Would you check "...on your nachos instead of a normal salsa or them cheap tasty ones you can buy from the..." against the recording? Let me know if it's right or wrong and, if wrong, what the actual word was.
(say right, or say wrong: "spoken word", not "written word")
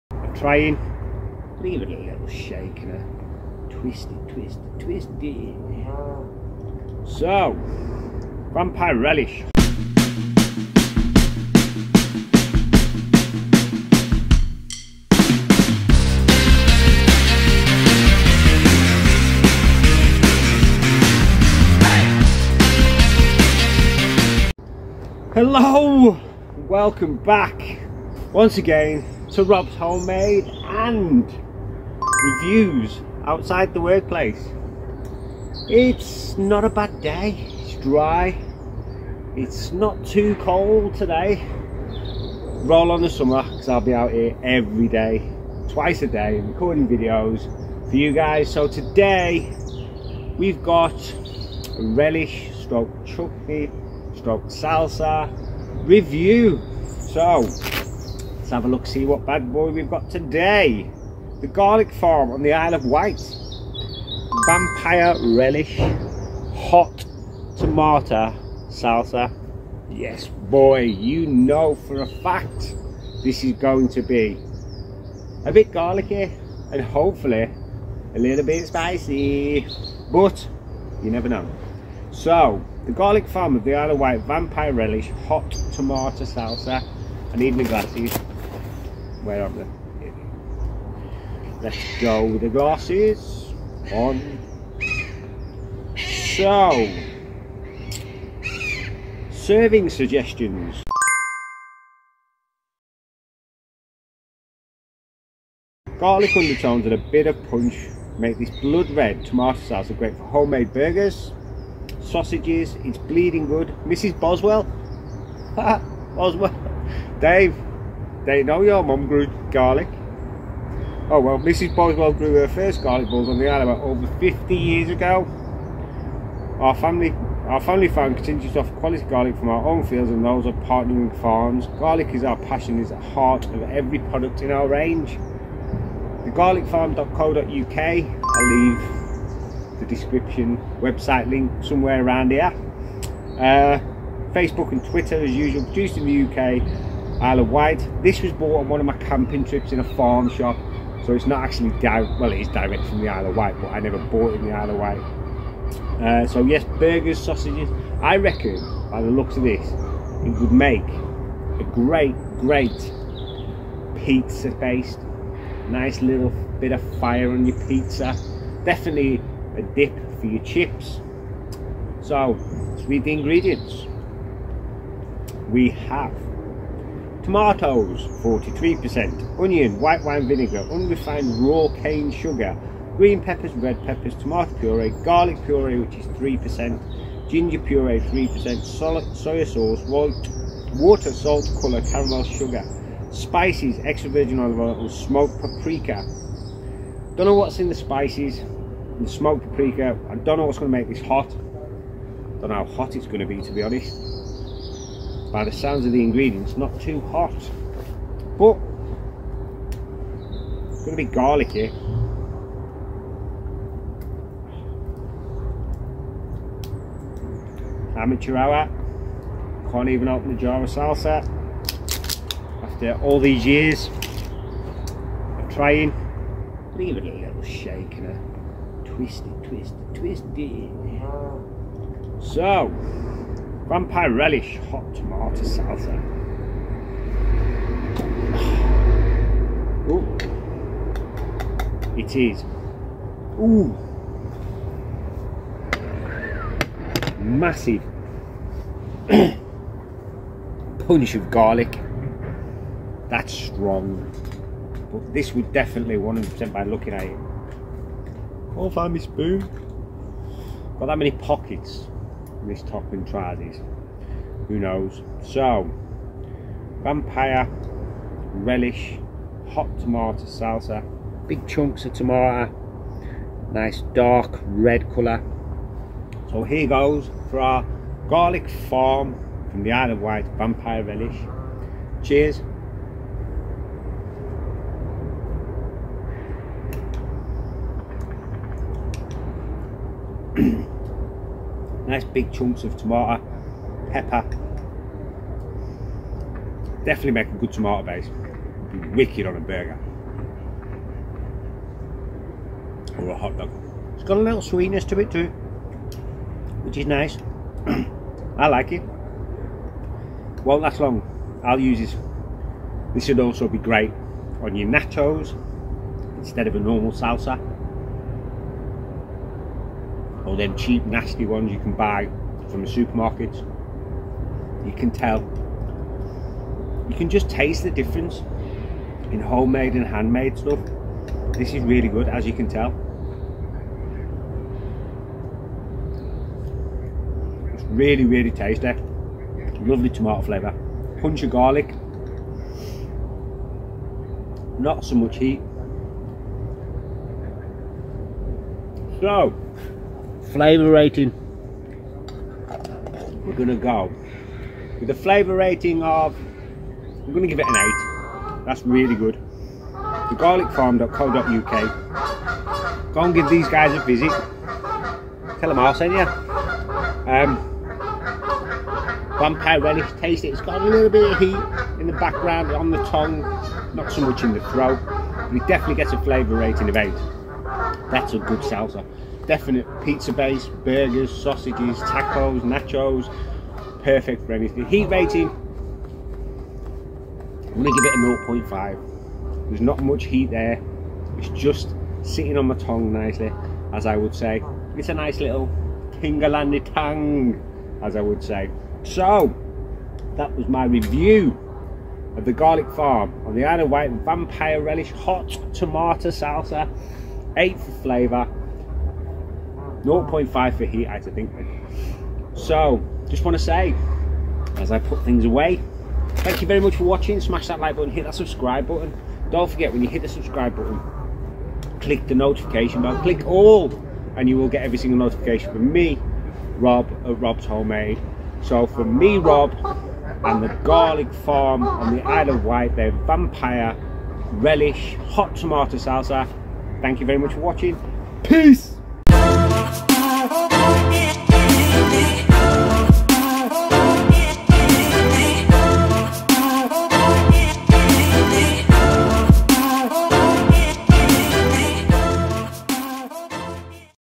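wrong: "nasty", not "tasty".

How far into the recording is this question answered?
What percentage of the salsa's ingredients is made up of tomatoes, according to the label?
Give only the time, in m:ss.
2:58.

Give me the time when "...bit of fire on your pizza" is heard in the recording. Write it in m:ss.
2:46.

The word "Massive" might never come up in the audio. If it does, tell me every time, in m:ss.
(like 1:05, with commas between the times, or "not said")
4:07.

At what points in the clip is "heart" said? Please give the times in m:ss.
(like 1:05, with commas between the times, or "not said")
2:13.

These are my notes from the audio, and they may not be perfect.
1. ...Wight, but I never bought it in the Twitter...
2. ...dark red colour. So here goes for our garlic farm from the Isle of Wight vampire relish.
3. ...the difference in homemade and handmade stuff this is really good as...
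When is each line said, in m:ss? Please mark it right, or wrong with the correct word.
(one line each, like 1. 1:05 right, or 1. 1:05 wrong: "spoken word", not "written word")
1. 2:33 wrong: "Isle", not "Twitter"
2. 4:33 right
3. 5:27 right.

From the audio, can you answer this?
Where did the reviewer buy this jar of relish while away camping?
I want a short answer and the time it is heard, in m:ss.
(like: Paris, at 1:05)
a farm shop, at 2:29.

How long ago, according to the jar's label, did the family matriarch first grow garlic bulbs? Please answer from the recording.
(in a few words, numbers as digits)
over 50 years ago.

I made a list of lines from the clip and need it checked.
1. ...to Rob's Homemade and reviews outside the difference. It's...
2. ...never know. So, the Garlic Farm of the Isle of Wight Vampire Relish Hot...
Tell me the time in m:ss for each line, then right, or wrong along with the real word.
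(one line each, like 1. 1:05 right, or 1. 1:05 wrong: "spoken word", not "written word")
1. 0:29 wrong: "workplace", not "difference"
2. 1:21 right.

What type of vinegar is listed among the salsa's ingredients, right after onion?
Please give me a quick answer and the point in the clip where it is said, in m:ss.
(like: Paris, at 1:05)
white wine vinegar, at 2:59.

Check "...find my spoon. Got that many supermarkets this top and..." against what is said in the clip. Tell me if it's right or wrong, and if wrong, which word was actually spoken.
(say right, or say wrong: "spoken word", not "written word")
wrong: "pockets", not "supermarkets".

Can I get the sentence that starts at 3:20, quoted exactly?
I don't know what's going to make this hot.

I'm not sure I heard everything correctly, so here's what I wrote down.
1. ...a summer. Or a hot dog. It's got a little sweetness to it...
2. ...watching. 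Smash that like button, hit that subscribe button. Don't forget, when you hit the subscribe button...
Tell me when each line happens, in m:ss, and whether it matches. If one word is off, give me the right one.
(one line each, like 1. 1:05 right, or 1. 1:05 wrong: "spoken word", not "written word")
1. 4:59 wrong: "burger", not "summer"
2. 6:56 right.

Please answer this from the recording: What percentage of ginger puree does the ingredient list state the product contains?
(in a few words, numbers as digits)
3%.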